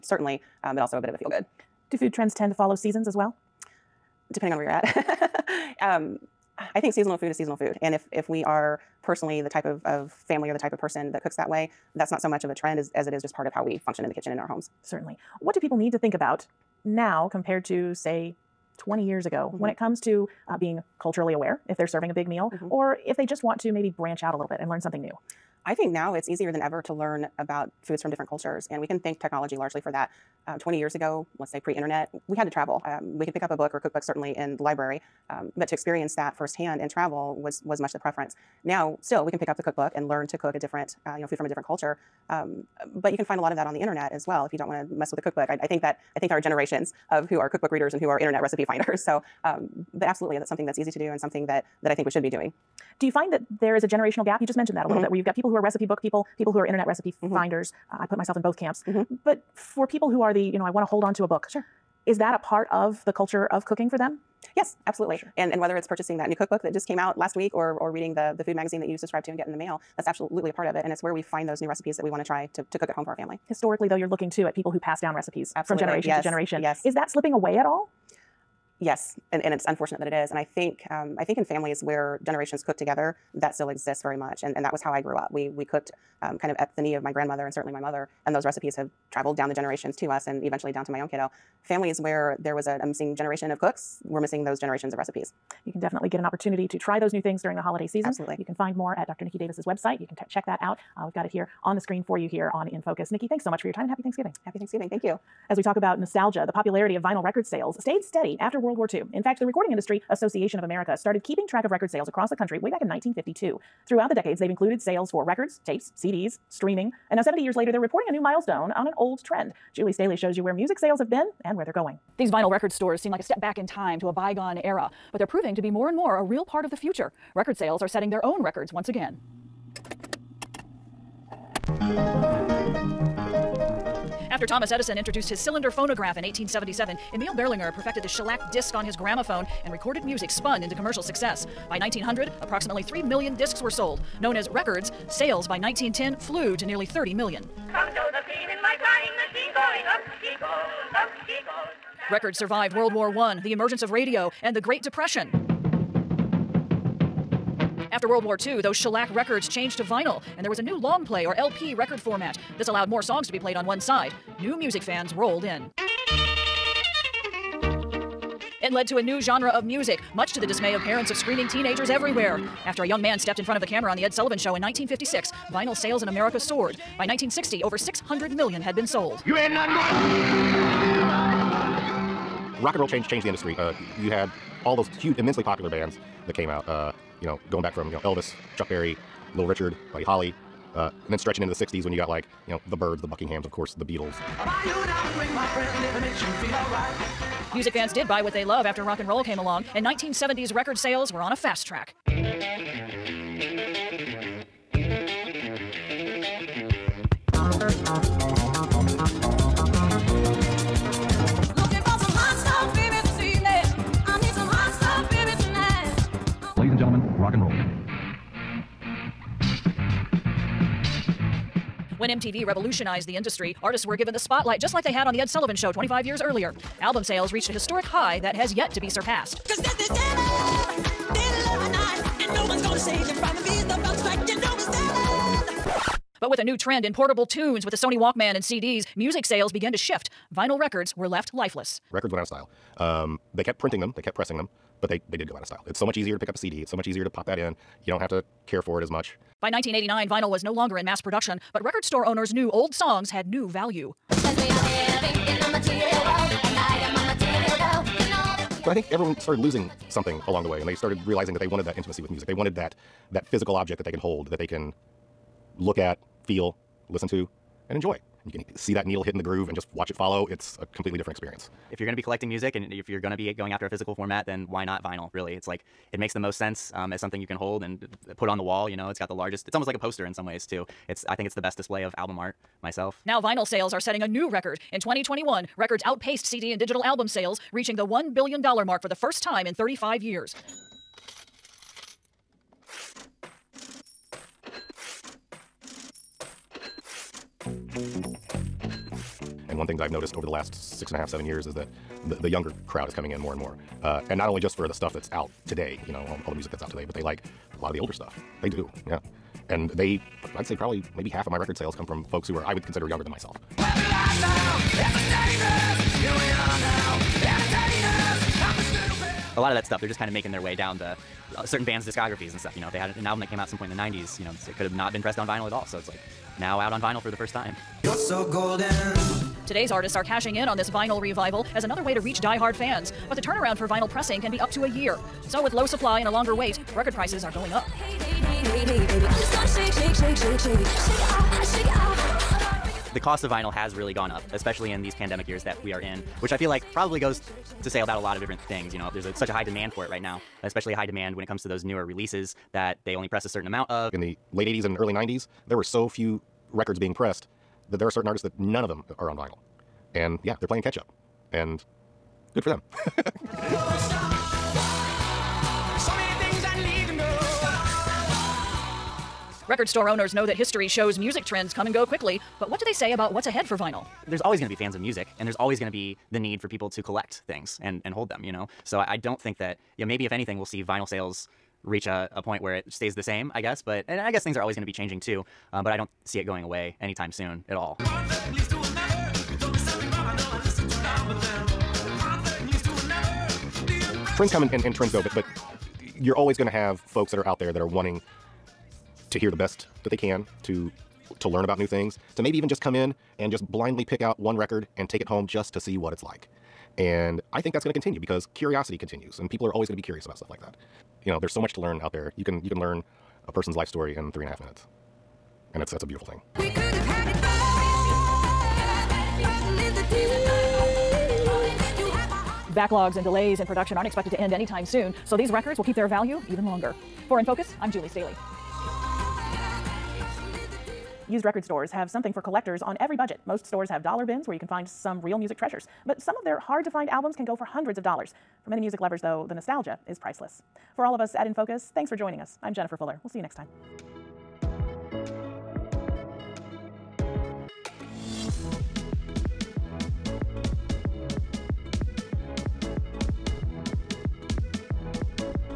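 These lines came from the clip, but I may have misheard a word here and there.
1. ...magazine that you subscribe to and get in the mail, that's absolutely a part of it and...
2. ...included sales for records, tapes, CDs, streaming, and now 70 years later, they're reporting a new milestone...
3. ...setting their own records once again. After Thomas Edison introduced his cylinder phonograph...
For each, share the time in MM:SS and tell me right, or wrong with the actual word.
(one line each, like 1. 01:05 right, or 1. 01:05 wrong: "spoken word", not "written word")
1. 01:08 right
2. 01:54 right
3. 02:07 right.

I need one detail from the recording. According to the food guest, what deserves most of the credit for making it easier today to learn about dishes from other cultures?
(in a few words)
technology.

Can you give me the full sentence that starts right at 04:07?
You don't have to care for it as much.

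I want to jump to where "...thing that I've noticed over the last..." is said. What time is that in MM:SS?
04:59.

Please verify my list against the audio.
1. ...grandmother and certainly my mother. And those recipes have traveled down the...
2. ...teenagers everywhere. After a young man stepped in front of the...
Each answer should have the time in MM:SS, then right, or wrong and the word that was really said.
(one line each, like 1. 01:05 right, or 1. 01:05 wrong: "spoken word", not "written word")
1. 01:27 right
2. 02:51 right.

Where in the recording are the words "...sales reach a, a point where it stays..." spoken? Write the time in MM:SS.
06:20.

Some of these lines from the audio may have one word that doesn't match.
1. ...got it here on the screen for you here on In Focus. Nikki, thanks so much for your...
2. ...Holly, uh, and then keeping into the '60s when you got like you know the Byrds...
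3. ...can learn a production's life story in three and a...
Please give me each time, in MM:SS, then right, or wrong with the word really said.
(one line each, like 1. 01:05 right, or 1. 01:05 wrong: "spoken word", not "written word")
1. 01:41 right
2. 03:10 wrong: "stretching", not "keeping"
3. 06:52 wrong: "person", not "production".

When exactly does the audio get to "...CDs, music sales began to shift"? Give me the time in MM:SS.
03:58.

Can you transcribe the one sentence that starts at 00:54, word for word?
You just mentioned that a little mm-hmm.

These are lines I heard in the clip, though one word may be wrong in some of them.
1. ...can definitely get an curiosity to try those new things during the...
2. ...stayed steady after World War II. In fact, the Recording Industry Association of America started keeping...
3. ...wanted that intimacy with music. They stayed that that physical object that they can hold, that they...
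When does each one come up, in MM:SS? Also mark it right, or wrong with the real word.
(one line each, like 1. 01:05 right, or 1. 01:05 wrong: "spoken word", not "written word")
1. 01:35 wrong: "opportunity", not "curiosity"
2. 01:47 right
3. 04:21 wrong: "wanted", not "stayed".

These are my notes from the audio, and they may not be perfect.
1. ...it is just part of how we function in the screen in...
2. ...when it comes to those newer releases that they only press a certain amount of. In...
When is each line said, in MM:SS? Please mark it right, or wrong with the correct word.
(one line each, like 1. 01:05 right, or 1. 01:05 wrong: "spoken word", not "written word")
1. 00:13 wrong: "kitchen", not "screen"
2. 05:51 right.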